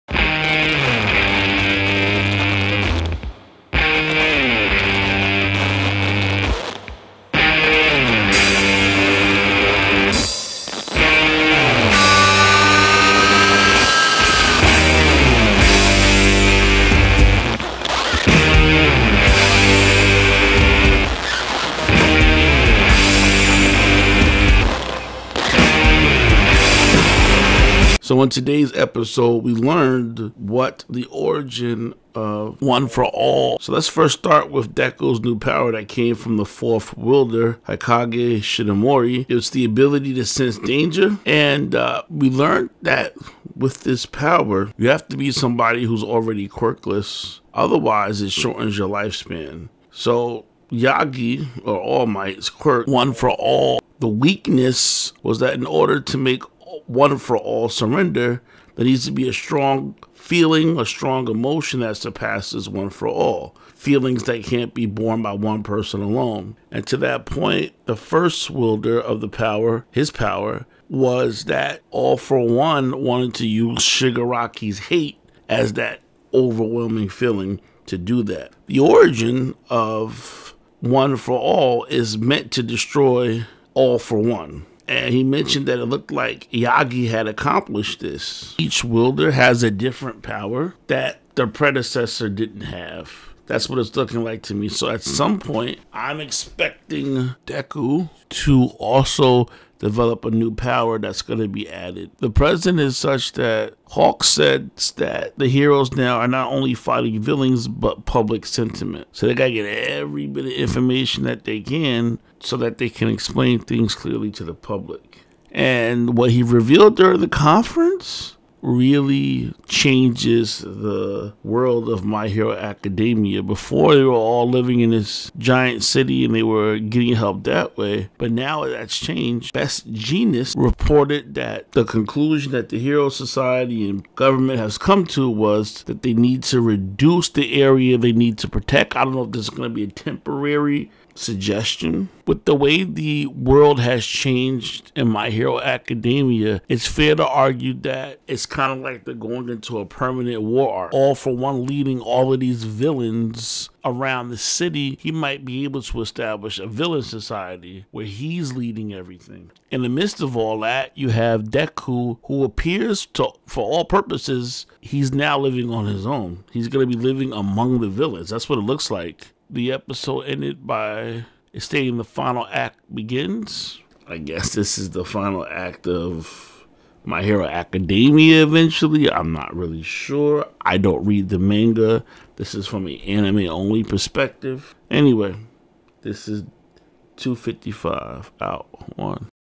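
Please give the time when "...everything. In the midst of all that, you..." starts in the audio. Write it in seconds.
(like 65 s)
158 s.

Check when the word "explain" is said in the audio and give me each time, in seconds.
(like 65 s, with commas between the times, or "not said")
113 s.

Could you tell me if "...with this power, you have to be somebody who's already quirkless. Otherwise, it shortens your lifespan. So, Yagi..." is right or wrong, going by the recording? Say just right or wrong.
right.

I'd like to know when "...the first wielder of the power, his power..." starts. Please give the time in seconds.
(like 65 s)
67 s.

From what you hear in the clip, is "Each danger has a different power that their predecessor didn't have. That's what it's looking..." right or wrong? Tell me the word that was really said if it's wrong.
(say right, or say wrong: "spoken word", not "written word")
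wrong: "wielder", not "danger".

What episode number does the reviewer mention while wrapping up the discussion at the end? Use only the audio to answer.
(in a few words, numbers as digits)
255.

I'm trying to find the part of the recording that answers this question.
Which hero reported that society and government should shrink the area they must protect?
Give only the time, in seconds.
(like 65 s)
129 s.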